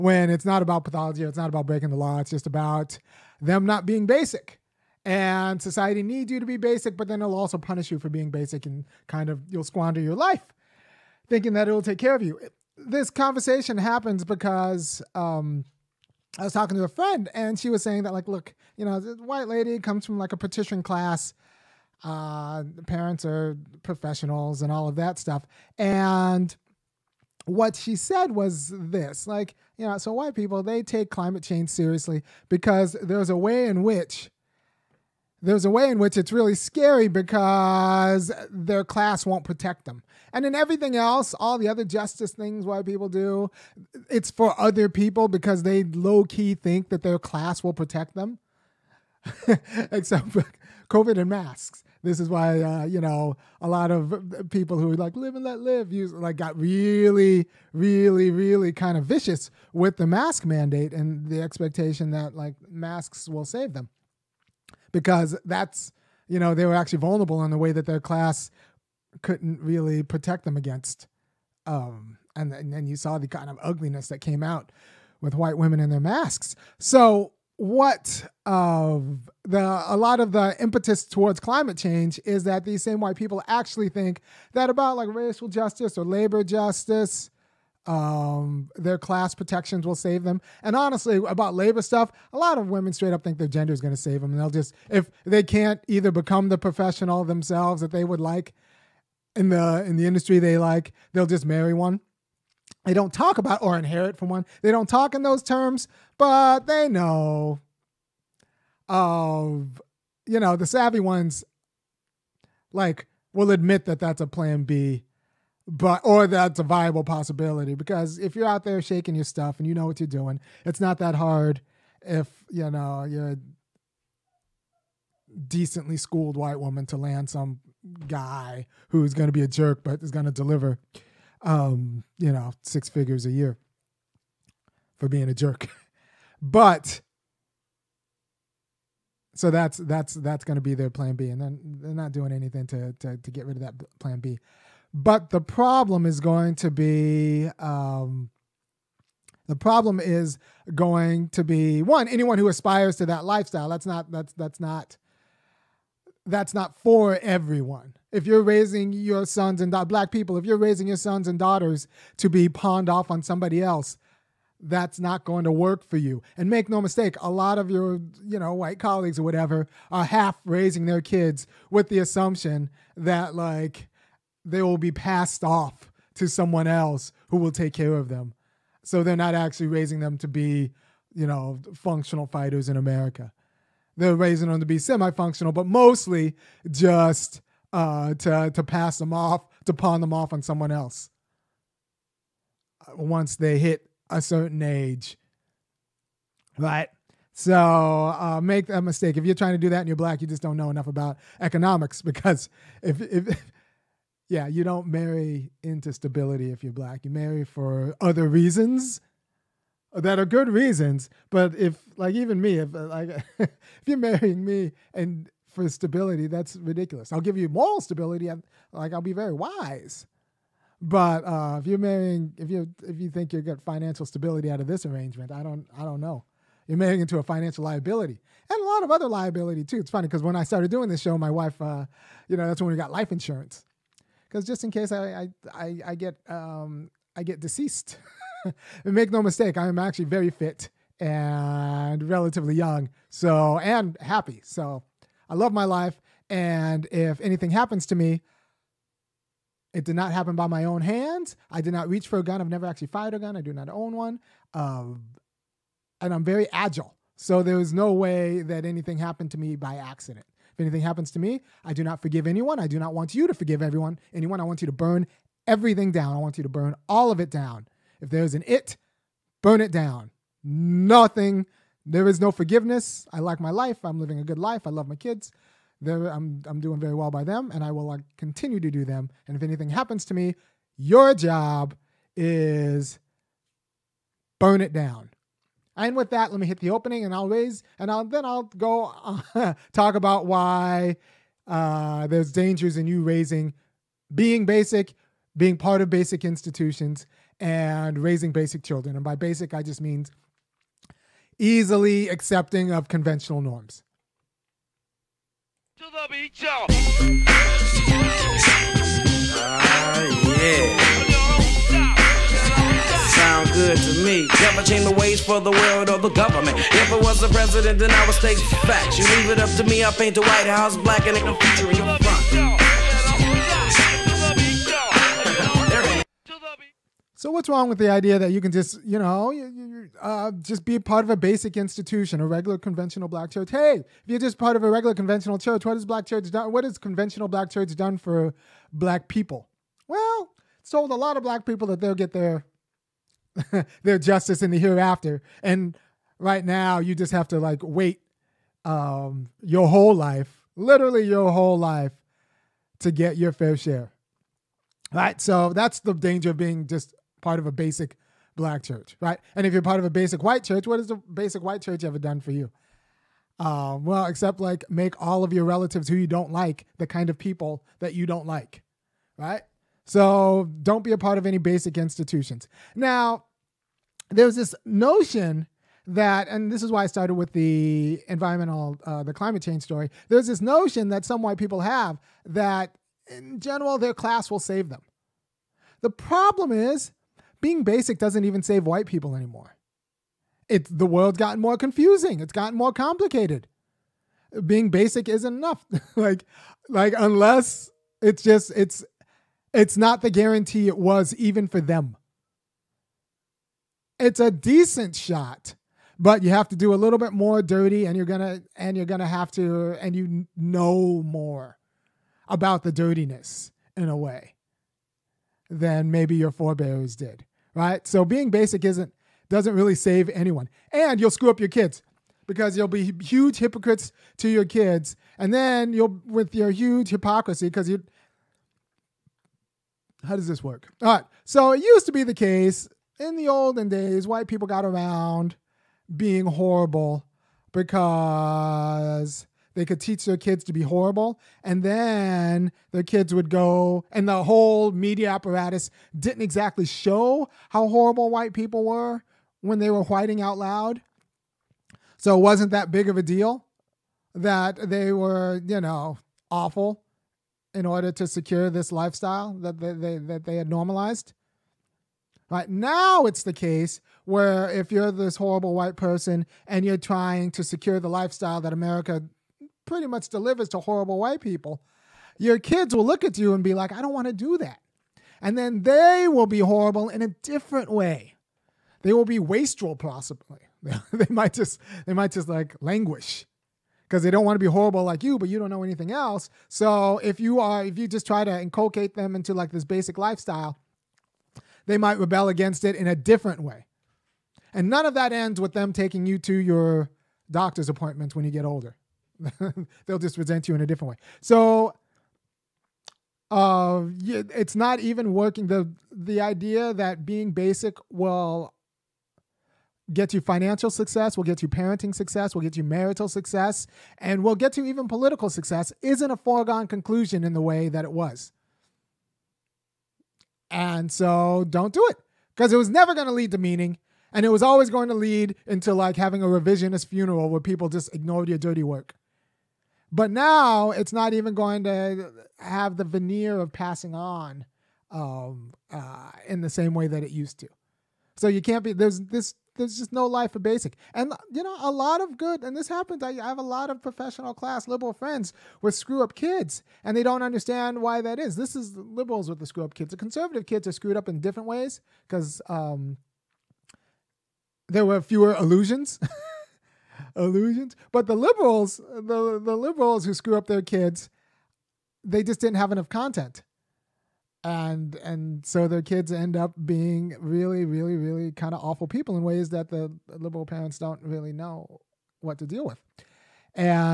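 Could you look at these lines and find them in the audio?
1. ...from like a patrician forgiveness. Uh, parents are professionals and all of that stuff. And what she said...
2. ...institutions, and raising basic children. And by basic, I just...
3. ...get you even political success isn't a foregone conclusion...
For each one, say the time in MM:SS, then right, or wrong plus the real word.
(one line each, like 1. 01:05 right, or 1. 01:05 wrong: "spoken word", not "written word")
1. 00:20 wrong: "class", not "forgiveness"
2. 04:56 right
3. 08:34 right.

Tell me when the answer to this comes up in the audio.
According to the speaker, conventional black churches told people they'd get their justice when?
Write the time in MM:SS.
05:44.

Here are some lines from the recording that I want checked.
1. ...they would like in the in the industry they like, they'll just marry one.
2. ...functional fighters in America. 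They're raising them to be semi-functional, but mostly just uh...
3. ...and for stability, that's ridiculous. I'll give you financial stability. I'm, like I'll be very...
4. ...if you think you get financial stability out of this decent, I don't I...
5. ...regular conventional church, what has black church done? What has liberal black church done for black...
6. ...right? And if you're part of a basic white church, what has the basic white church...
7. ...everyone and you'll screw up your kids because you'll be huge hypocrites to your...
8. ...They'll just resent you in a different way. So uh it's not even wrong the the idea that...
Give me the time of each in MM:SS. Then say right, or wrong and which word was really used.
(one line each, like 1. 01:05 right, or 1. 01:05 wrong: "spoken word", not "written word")
1. 01:37 right
2. 03:01 right
3. 03:34 wrong: "moral", not "financial"
4. 03:42 wrong: "arrangement", not "decent"
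5. 05:34 wrong: "conventional", not "liberal"
6. 05:59 right
7. 07:00 wrong: "anyone", not "everyone"
8. 08:19 wrong: "working", not "wrong".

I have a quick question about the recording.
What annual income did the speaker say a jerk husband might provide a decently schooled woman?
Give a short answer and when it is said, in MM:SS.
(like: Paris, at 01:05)
Six figures, at 02:12.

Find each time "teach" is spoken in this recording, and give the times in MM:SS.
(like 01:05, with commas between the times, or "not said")
07:19.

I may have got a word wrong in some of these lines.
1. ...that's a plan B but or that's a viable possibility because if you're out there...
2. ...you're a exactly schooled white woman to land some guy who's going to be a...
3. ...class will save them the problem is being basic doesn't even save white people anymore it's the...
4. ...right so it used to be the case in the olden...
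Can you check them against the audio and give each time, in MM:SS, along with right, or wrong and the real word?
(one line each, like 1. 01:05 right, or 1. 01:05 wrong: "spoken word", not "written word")
1. 01:53 right
2. 02:03 wrong: "decently", not "exactly"
3. 06:23 right
4. 07:10 right.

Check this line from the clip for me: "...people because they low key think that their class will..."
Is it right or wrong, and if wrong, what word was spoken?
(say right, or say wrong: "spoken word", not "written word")
right.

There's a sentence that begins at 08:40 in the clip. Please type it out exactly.
And so don't do it because it was never going to lead to meaning.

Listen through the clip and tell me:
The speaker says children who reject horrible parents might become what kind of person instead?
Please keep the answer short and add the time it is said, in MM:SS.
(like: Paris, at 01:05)
Wastrel, at 07:59.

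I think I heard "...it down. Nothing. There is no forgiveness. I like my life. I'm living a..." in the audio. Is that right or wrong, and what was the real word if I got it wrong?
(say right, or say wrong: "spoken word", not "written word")
right.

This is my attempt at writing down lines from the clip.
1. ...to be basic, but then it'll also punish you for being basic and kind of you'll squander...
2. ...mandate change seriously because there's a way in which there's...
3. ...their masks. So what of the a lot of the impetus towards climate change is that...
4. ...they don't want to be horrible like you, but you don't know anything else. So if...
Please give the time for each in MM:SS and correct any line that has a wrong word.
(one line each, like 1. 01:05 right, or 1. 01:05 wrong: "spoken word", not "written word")
1. 00:06 right
2. 00:31 wrong: "climate", not "mandate"
3. 01:15 right
4. 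08:04 right.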